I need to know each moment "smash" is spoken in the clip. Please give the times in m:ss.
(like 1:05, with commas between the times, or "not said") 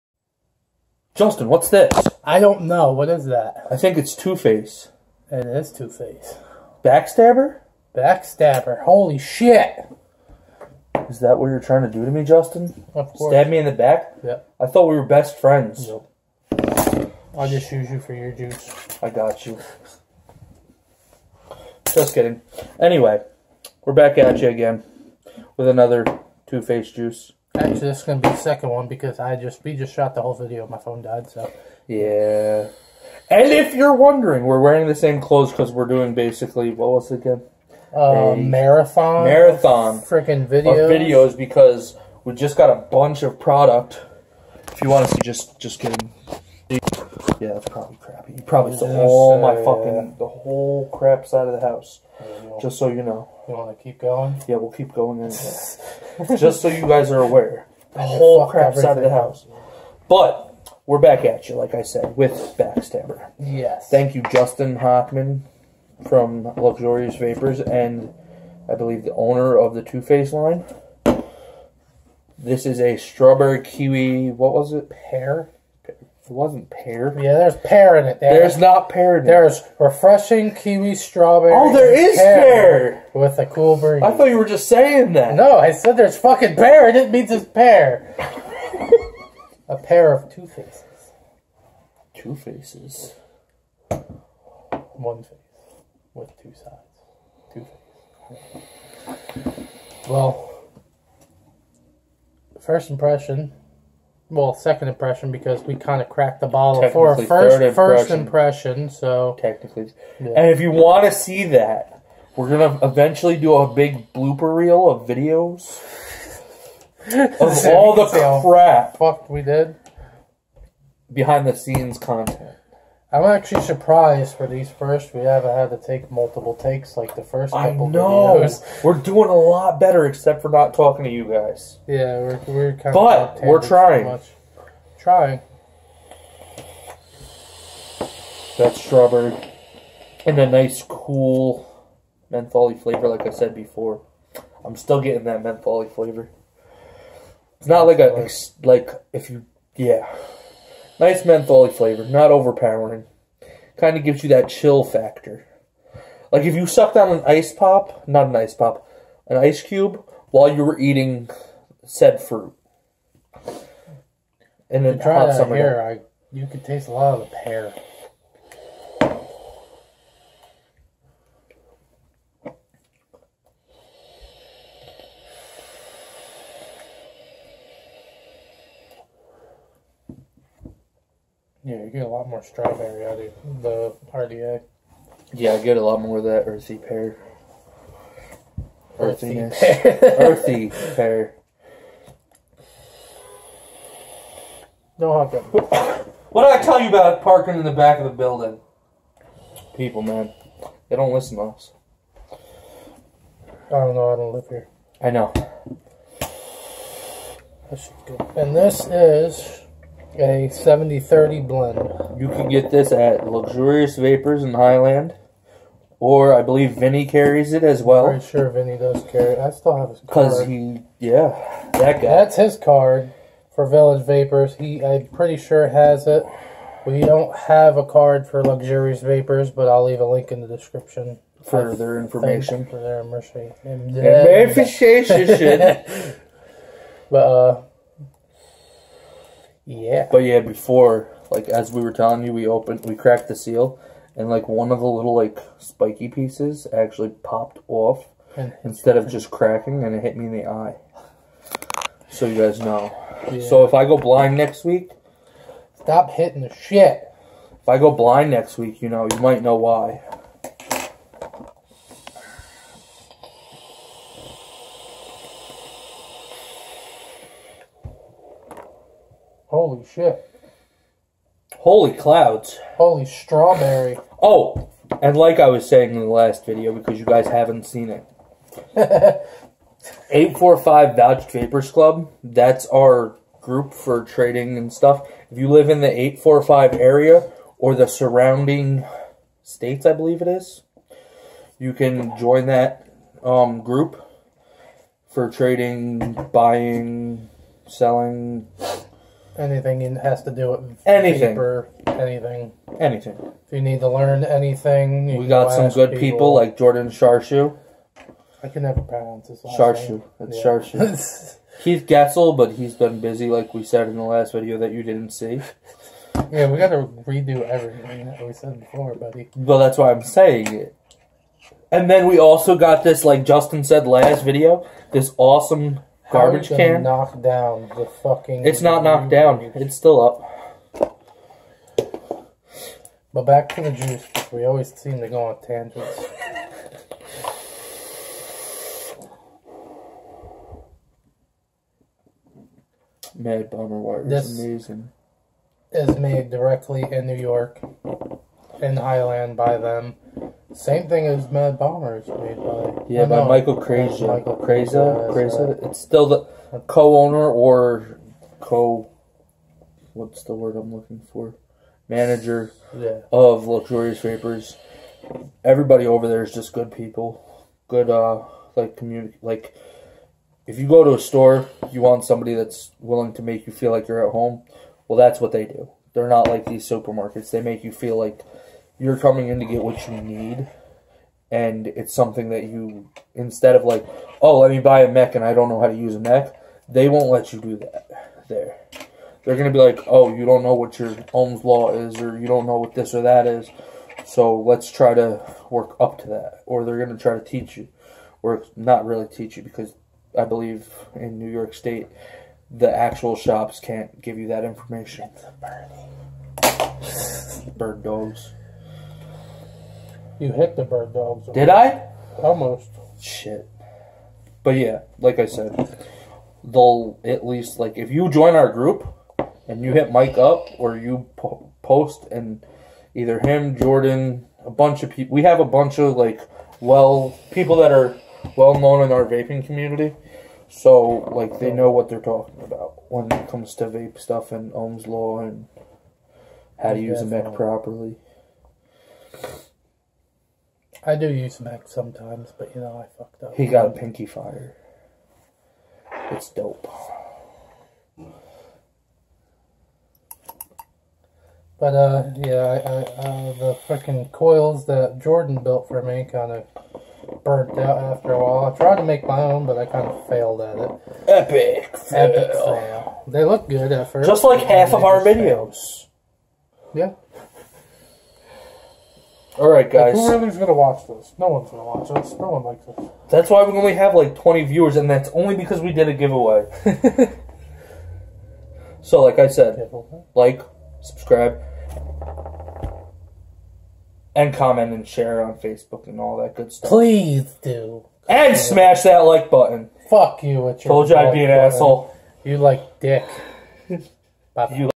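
8:08.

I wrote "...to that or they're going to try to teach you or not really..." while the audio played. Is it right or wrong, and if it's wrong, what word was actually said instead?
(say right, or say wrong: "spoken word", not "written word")
right.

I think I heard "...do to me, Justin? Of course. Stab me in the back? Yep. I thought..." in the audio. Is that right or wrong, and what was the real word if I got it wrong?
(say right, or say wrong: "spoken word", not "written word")
right.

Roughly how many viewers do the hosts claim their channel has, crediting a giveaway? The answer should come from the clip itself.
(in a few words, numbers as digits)
20.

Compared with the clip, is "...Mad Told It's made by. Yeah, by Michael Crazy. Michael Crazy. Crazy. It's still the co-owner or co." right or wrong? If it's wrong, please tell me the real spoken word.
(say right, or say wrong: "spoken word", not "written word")
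wrong: "Bomber", not "Told".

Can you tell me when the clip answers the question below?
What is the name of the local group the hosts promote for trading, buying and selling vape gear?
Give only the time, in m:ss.
4:40.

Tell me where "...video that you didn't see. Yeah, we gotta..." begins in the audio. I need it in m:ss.
5:14.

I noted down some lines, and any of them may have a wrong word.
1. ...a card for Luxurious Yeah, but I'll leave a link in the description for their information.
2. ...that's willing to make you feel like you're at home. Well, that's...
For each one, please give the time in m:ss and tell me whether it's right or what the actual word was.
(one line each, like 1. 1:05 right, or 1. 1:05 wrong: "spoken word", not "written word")
1. 3:47 wrong: "Vapors", not "Yeah"
2. 6:12 right.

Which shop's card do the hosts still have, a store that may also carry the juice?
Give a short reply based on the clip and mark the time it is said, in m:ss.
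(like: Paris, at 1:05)
Village Vapors, at 3:43.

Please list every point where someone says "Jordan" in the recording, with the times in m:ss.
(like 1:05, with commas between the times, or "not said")
5:06, 7:03, 7:34.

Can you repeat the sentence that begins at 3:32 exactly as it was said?
You can get this at Luxurious Vapors in Highland.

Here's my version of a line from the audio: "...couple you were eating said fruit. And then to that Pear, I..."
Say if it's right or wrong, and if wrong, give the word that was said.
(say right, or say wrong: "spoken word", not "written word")
wrong: "while", not "couple".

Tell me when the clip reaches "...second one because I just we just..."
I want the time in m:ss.
0:28.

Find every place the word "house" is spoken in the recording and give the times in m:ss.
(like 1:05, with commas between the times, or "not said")
0:51, 0:59.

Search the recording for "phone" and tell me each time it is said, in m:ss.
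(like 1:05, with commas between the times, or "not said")
0:30.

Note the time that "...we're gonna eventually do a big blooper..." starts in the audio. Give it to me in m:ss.
1:52.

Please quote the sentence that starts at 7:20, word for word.
I do use mech sometimes, but you know, I fucked up.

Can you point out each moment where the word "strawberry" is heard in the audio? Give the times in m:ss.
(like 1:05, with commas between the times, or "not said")
1:12, 1:20, 2:18, 3:02, 4:33.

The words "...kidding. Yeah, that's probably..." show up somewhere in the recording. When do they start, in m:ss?
0:45.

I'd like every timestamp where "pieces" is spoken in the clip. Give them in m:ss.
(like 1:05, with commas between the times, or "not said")
4:06.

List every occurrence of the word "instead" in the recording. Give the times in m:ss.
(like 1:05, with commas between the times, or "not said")
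4:08, 6:23.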